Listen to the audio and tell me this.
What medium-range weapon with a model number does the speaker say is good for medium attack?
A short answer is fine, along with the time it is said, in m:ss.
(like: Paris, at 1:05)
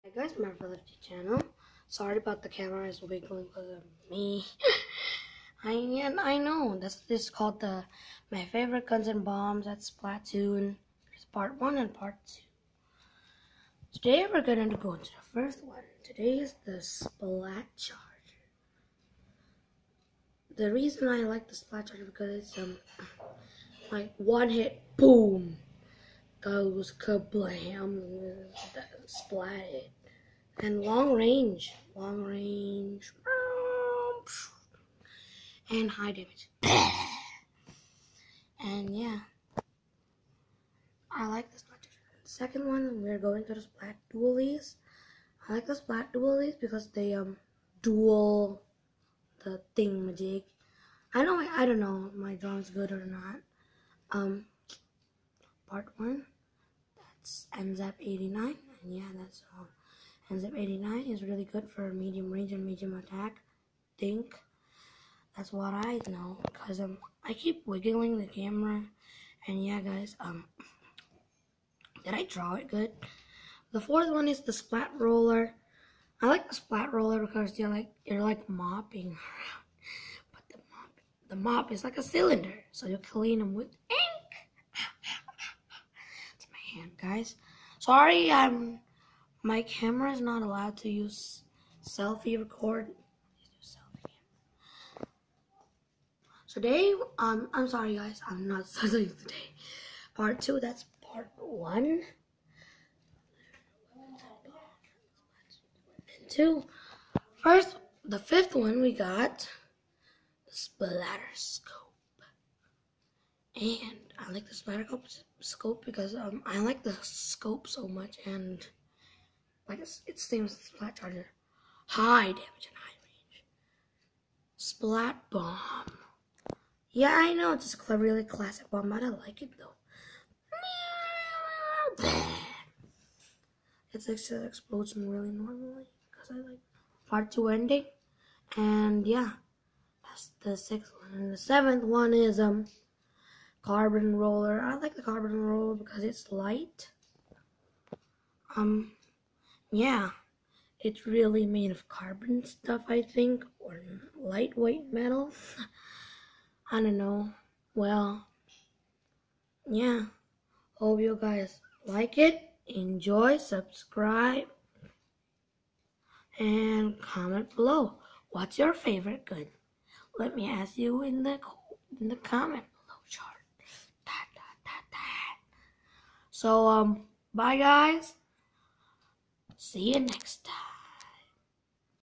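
N-ZAP 89, at 0:57.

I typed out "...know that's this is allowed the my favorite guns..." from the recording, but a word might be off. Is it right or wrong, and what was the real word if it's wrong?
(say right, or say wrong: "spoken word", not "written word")
wrong: "called", not "allowed".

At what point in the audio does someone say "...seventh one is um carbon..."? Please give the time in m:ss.
2:21.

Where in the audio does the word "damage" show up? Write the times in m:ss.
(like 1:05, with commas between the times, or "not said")
0:36, 2:02.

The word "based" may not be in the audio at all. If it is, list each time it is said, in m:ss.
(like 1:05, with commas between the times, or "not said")
not said.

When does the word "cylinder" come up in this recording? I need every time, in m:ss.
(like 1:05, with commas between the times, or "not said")
1:22.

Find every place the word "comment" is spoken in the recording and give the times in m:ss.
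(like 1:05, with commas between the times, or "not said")
2:46, 2:52.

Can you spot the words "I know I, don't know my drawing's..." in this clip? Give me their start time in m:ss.
0:51.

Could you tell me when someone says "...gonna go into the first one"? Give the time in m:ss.
0:14.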